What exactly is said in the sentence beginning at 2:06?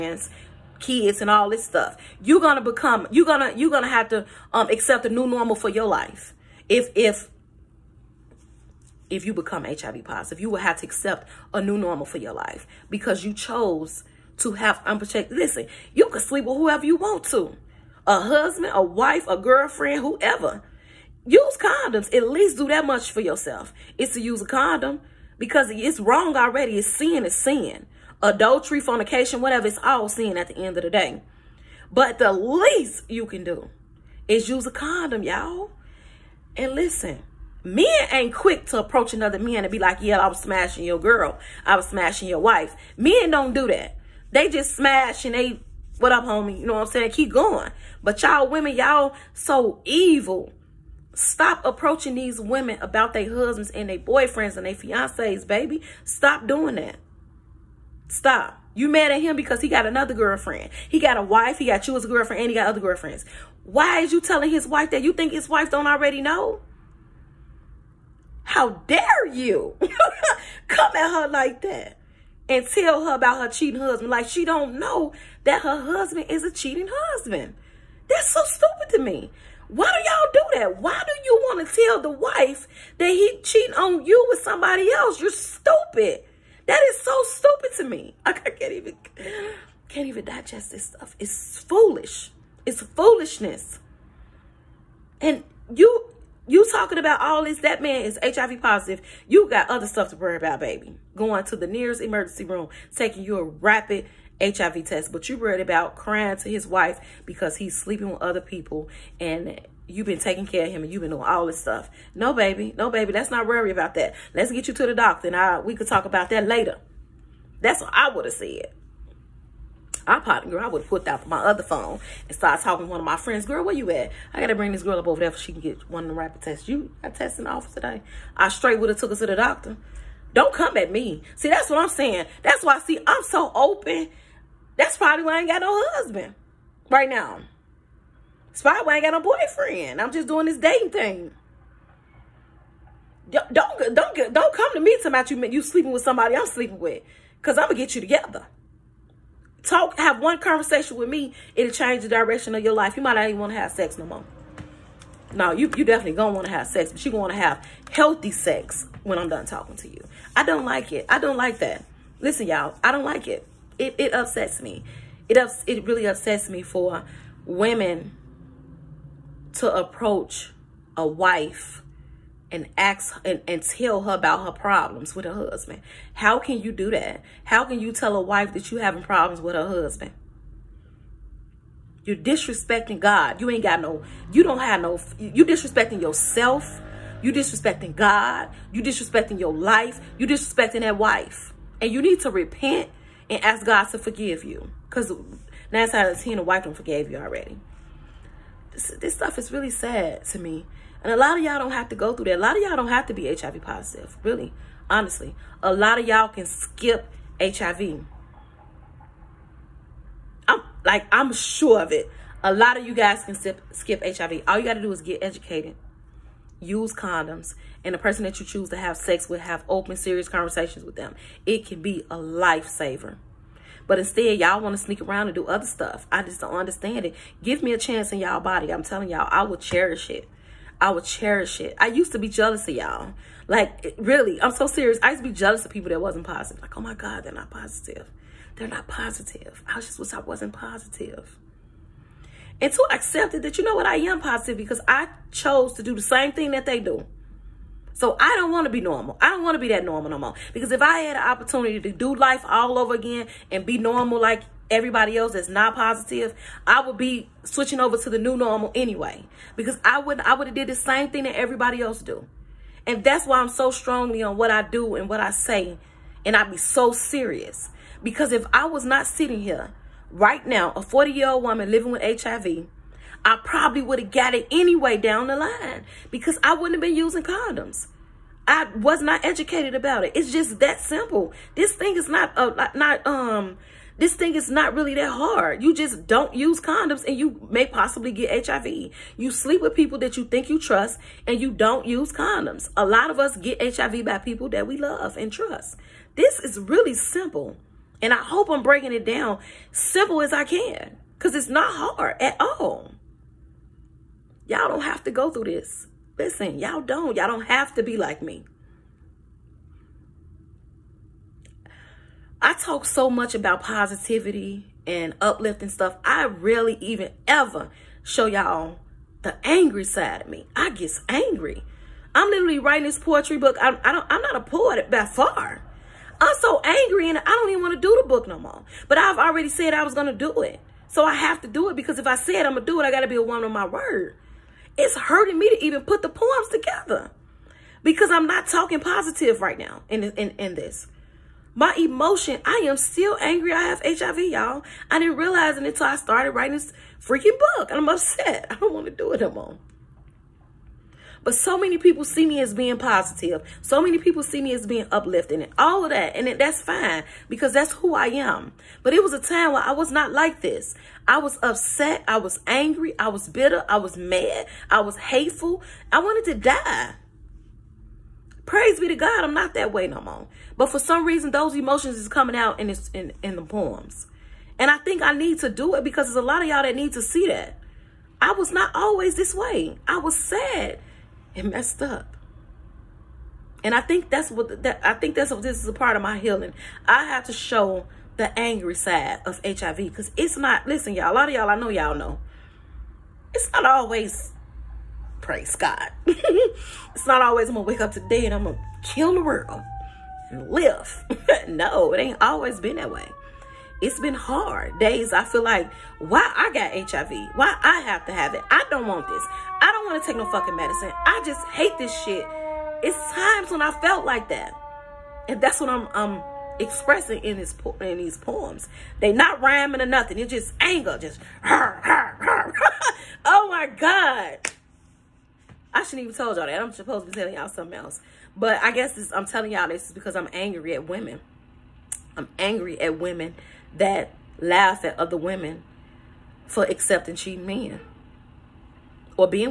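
You got tests in the office today.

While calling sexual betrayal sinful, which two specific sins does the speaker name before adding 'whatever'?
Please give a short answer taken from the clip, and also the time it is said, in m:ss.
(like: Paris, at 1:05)
Adultery, fornication, at 0:28.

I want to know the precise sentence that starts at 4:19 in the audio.
Because I would I would have did the same thing that everybody else do.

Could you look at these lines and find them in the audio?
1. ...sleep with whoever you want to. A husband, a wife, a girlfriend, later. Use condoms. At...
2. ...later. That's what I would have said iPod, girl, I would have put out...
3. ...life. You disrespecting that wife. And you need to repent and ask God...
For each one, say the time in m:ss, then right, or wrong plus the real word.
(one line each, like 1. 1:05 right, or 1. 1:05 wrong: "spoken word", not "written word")
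1. 0:16 wrong: "whoever", not "later"
2. 1:56 right
3. 3:09 right.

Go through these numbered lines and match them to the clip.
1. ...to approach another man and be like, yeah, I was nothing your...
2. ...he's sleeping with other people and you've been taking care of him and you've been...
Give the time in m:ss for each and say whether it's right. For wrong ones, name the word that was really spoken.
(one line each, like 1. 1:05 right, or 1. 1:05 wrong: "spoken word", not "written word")
1. 0:38 wrong: "smashing", not "nothing"
2. 1:47 right.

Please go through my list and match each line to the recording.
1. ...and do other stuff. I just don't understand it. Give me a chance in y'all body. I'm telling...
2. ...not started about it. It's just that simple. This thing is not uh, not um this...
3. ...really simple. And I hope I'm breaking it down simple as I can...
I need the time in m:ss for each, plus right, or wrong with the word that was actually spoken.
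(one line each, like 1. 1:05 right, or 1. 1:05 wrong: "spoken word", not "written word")
1. 3:45 right
2. 4:39 wrong: "educated", not "started"
3. 4:56 right.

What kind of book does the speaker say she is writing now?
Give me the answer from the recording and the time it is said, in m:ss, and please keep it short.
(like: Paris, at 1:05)
Poetry book, at 5:22.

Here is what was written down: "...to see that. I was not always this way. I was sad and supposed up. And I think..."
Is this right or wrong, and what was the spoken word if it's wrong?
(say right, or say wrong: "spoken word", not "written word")
wrong: "messed", not "supposed".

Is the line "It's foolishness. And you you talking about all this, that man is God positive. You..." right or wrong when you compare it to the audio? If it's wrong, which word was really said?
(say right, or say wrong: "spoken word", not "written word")
wrong: "HIV", not "God".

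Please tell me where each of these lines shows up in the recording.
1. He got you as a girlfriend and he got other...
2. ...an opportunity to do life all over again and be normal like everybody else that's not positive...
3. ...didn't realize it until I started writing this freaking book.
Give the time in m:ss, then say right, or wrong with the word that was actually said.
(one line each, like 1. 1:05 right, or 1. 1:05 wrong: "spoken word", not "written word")
1. 1:01 right
2. 4:11 right
3. 5:44 right.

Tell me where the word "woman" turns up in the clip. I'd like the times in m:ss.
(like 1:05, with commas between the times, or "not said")
4:31, 5:33.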